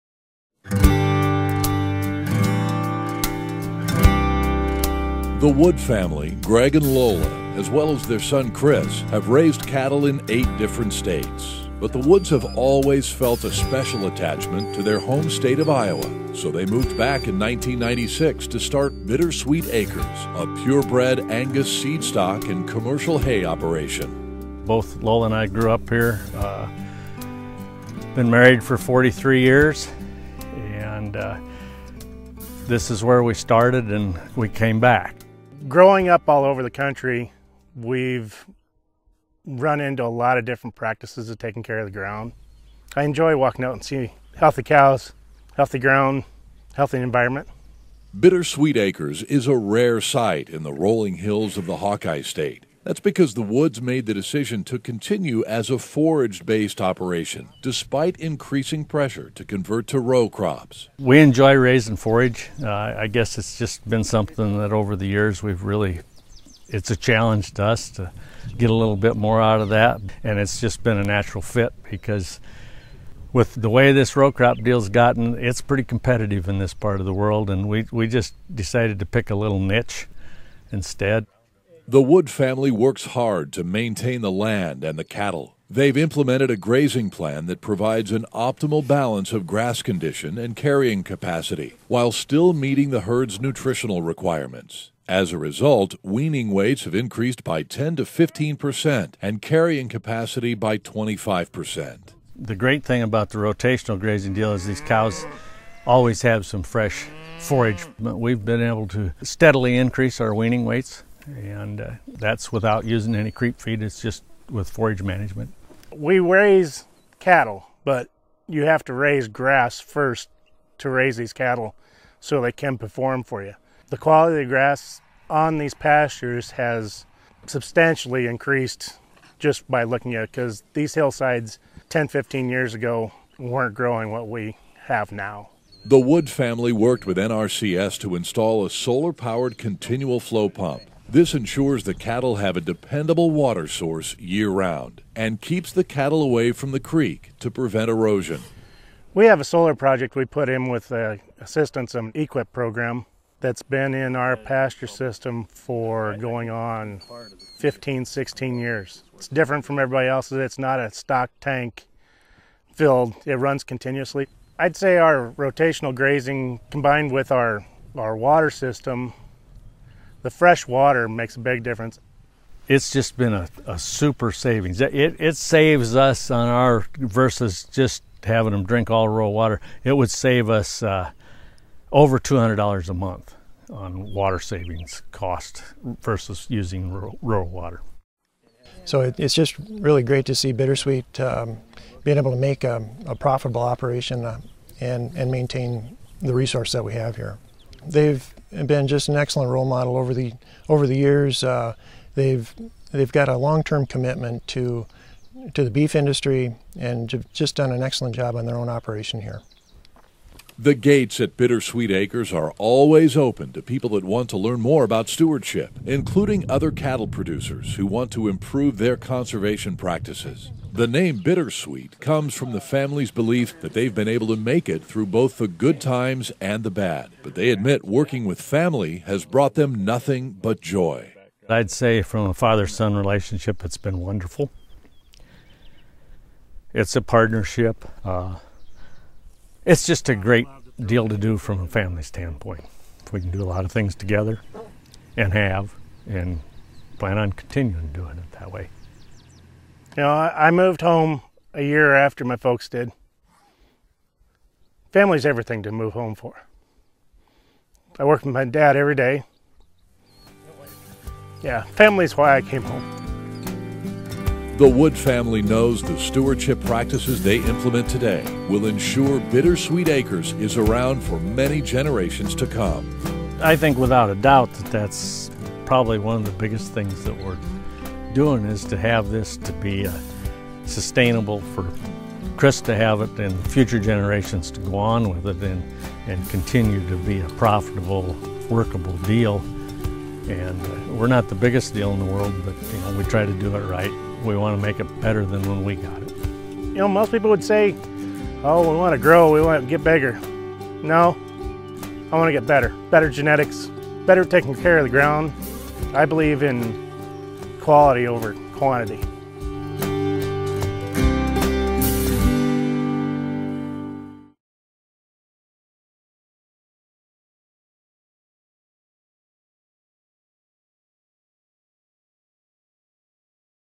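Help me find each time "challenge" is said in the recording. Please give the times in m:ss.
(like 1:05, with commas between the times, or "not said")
1:06.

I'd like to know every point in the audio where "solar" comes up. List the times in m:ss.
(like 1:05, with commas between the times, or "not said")
2:18, 2:29.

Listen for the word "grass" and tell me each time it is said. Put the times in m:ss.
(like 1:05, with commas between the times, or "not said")
1:29, 1:59, 2:04.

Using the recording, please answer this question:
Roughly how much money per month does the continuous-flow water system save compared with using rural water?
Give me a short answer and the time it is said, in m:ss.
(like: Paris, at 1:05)
over $200, at 3:01.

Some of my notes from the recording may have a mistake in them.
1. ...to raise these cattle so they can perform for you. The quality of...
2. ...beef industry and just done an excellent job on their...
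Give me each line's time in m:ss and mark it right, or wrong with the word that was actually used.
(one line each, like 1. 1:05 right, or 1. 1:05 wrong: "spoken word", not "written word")
1. 2:00 right
2. 3:25 right.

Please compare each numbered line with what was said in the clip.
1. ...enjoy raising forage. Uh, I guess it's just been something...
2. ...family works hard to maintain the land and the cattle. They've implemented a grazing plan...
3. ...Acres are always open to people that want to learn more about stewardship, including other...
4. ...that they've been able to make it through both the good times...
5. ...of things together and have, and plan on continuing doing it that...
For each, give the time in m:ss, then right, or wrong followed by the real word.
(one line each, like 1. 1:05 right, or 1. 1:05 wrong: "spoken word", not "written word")
1. 1:01 right
2. 1:22 right
3. 3:31 right
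4. 3:43 right
5. 4:03 right.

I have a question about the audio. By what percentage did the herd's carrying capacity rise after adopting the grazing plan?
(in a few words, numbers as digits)
25 percent.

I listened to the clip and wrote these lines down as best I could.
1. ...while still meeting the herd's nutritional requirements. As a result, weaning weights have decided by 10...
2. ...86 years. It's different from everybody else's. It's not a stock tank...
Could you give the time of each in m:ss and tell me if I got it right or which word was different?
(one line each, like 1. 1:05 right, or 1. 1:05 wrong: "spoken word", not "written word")
1. 1:31 wrong: "increased", not "decided"
2. 2:38 wrong: "16", not "86".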